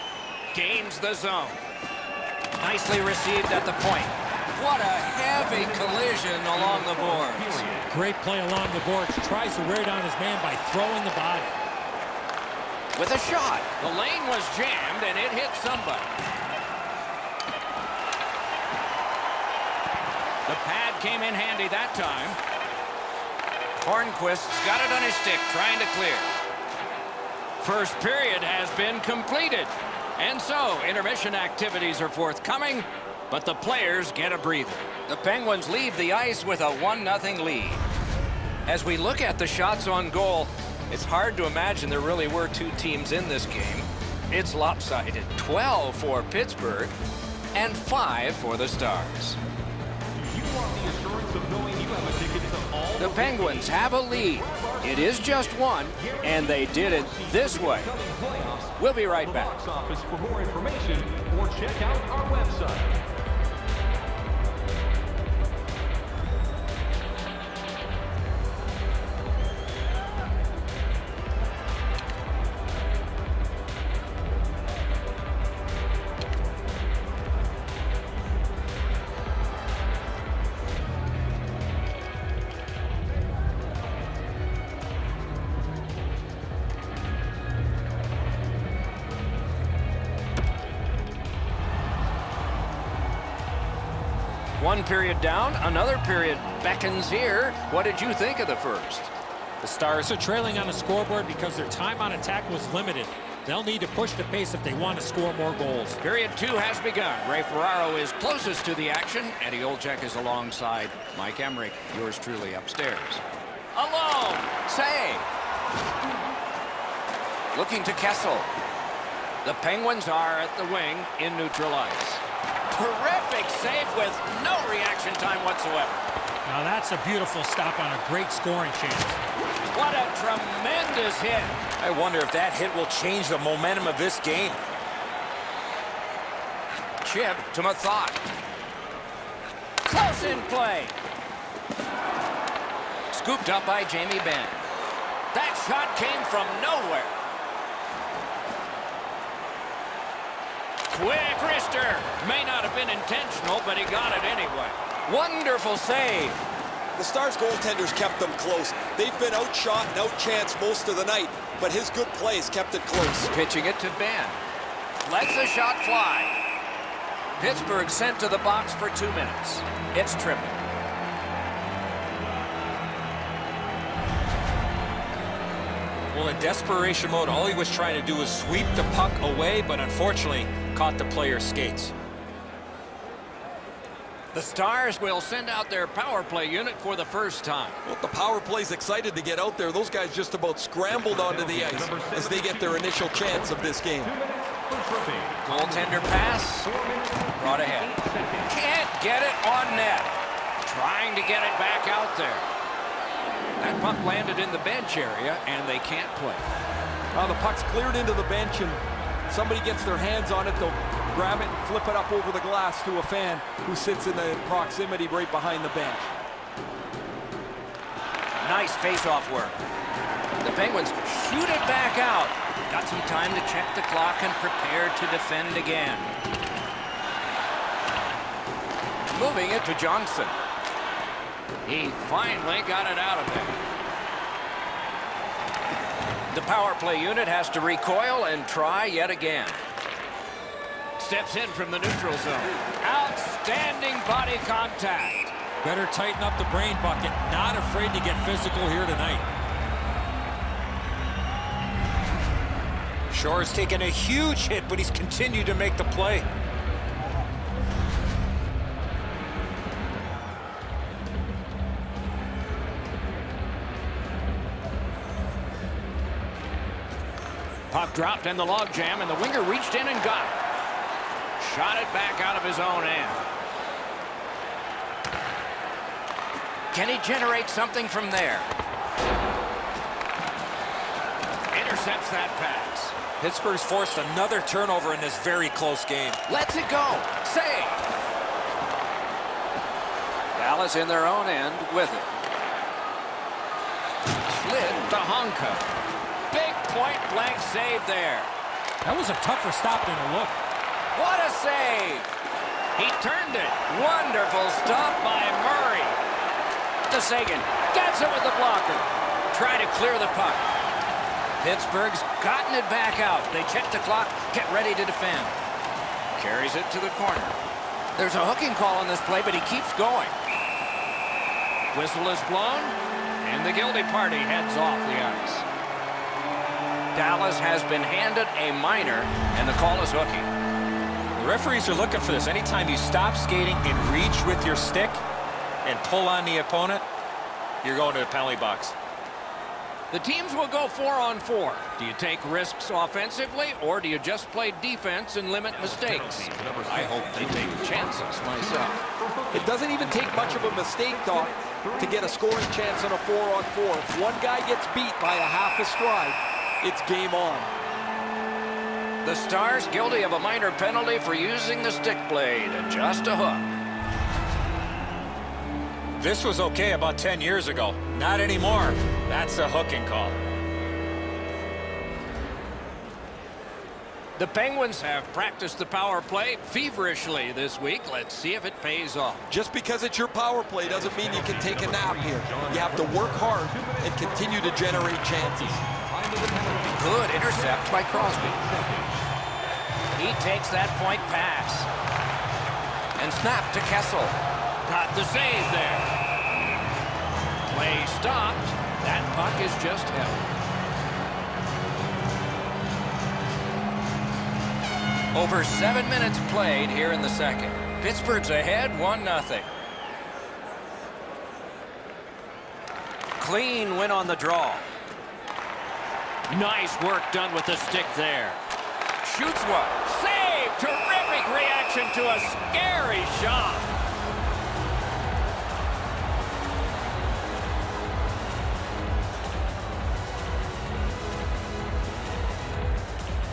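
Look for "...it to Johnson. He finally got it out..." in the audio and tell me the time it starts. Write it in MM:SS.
03:49.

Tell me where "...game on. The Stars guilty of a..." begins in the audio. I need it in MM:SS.
05:56.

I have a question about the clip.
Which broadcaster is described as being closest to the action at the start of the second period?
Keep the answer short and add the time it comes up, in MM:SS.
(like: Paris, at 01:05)
Ray Ferraro, at 01:47.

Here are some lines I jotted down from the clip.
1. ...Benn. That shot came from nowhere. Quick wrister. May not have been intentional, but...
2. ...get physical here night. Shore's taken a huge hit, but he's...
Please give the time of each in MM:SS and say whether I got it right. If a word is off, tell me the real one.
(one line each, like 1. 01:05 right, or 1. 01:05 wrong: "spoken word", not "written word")
1. 02:24 right
2. 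04:08 wrong: "tonight", not "night".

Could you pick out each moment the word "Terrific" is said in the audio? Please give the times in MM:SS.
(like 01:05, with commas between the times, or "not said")
02:02, 07:00.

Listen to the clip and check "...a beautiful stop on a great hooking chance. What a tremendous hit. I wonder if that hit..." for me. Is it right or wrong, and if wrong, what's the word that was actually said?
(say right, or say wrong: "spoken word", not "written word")
wrong: "scoring", not "hooking".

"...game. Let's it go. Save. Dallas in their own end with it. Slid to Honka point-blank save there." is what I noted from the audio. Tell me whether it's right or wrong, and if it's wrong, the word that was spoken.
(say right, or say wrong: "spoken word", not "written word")
right.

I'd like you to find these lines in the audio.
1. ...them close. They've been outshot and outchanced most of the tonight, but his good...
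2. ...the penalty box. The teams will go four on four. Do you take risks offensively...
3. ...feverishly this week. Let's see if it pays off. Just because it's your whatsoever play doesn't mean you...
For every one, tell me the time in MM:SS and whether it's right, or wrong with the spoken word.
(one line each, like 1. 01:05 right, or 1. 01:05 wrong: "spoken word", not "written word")
1. 02:38 wrong: "night", not "tonight"
2. 05:37 right
3. 06:16 wrong: "power", not "whatsoever".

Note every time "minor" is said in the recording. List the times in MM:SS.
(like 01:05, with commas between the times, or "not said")
05:28, 06:00.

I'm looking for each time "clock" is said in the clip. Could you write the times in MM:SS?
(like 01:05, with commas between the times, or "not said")
03:43, 05:13.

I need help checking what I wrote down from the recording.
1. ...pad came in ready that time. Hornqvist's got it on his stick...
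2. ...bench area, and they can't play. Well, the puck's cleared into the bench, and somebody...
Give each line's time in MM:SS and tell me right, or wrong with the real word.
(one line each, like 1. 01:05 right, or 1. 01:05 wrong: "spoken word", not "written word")
1. 00:20 wrong: "handy", not "ready"
2. 03:24 right.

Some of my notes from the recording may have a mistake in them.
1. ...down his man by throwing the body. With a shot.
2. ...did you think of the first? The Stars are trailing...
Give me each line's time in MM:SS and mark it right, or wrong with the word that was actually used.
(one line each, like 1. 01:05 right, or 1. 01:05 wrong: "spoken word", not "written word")
1. 00:09 right
2. 01:37 right.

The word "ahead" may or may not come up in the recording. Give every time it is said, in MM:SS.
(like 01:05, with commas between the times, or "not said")
03:17, 06:48.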